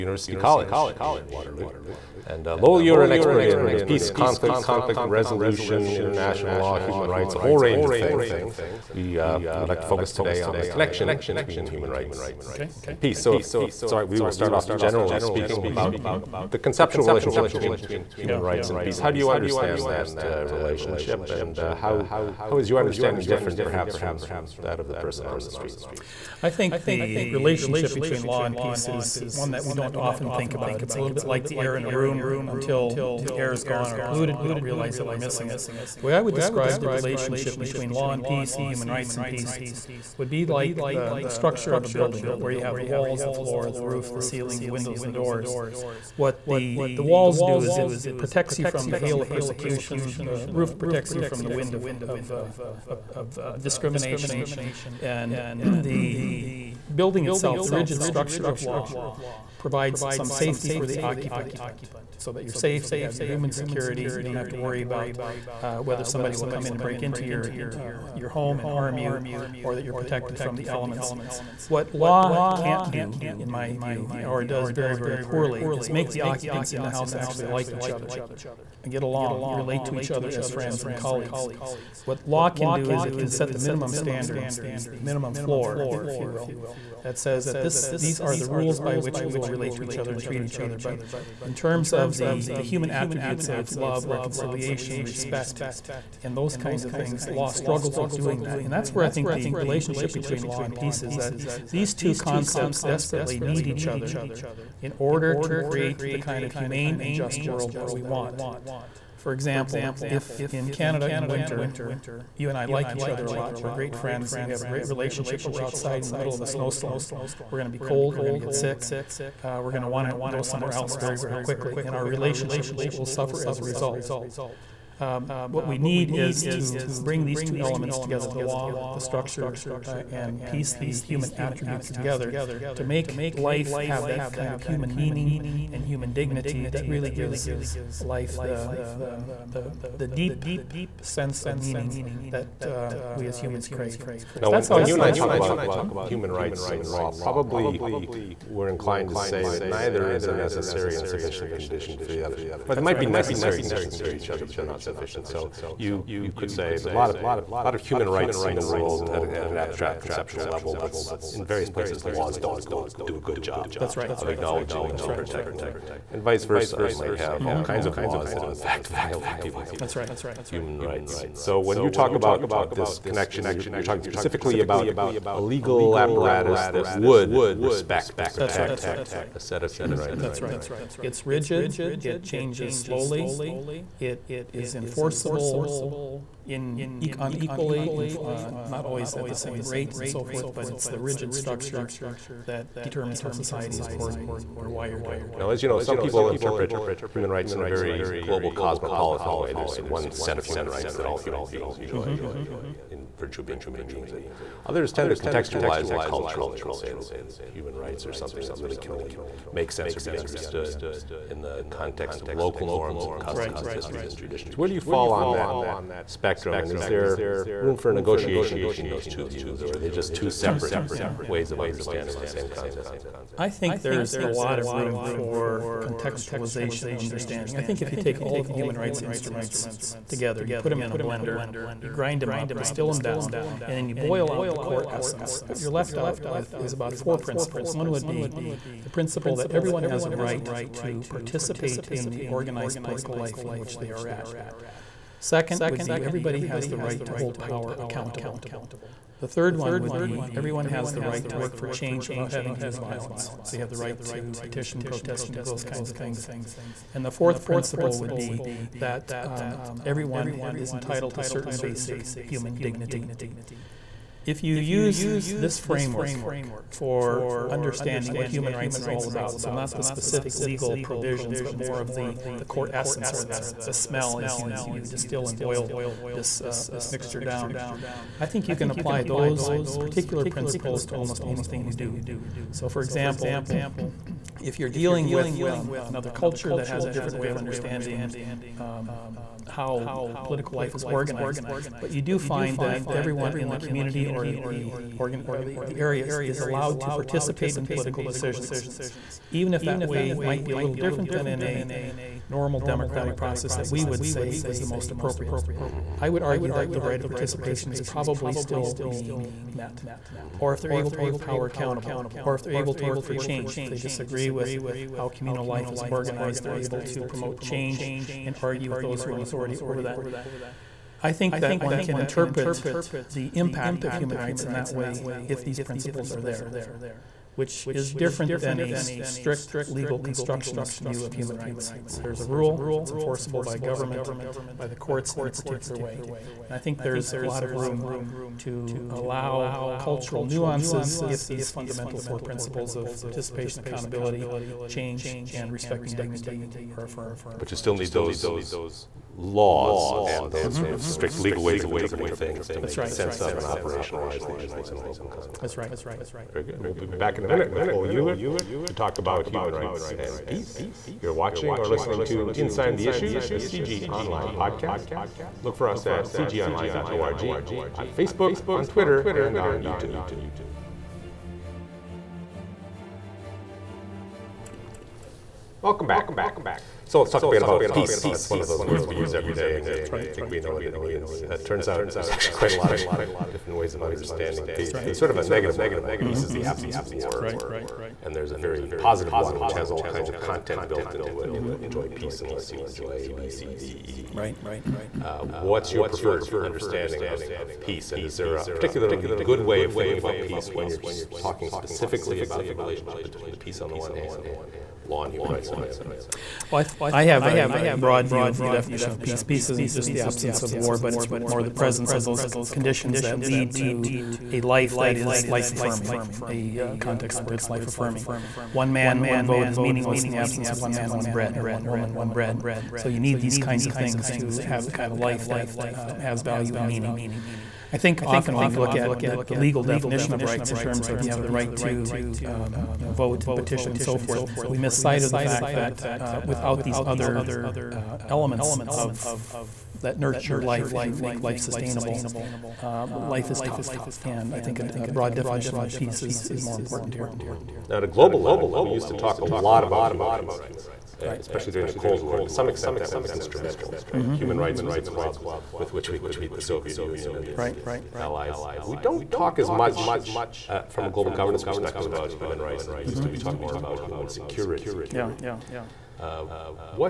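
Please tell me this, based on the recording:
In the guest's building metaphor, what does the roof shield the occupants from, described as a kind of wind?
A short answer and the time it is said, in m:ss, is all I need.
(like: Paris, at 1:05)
Discrimination, at 0:53.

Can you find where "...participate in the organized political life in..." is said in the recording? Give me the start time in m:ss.
4:01.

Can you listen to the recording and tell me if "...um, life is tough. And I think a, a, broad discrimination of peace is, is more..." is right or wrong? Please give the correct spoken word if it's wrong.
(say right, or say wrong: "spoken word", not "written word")
wrong: "definition", not "discrimination".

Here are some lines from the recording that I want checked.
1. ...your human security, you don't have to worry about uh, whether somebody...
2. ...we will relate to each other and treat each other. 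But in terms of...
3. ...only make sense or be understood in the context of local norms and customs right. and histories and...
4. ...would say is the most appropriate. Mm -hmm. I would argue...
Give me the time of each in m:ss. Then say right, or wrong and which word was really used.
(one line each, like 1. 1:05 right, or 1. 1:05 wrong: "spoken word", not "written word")
1. 1:03 right
2. 1:29 right
3. 3:28 right
4. 5:03 right.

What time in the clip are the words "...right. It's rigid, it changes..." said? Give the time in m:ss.
3:00.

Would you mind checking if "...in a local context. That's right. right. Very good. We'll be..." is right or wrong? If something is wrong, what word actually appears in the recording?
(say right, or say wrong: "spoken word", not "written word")
right.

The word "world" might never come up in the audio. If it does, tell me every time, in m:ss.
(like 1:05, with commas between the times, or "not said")
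1:47, 2:38.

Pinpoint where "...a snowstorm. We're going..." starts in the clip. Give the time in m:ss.
1:56.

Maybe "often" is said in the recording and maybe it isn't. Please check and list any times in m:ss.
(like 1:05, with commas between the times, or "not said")
0:29, 7:08.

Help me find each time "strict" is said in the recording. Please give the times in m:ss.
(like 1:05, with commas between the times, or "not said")
5:28, 5:50.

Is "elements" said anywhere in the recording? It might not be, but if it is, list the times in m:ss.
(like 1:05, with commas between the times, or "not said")
1:10, 2:07, 7:18.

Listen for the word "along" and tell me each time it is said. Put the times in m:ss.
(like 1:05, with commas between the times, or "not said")
1:19.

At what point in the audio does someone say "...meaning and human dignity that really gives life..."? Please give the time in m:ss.
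2:14.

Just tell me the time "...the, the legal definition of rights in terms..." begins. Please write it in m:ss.
7:09.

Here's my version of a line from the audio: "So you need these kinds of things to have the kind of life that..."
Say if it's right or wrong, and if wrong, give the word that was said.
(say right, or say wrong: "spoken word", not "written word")
right.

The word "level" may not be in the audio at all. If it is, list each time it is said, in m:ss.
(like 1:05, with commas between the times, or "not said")
2:40, 7:28.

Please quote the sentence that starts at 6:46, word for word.
Well, I, th- I, have a broad view of the definition of peace.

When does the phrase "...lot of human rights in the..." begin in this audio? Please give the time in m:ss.
2:37.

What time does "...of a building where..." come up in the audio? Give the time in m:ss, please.
0:41.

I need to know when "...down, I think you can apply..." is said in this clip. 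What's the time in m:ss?
4:37.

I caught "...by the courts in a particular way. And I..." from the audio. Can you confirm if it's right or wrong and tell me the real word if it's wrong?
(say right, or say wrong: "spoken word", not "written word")
right.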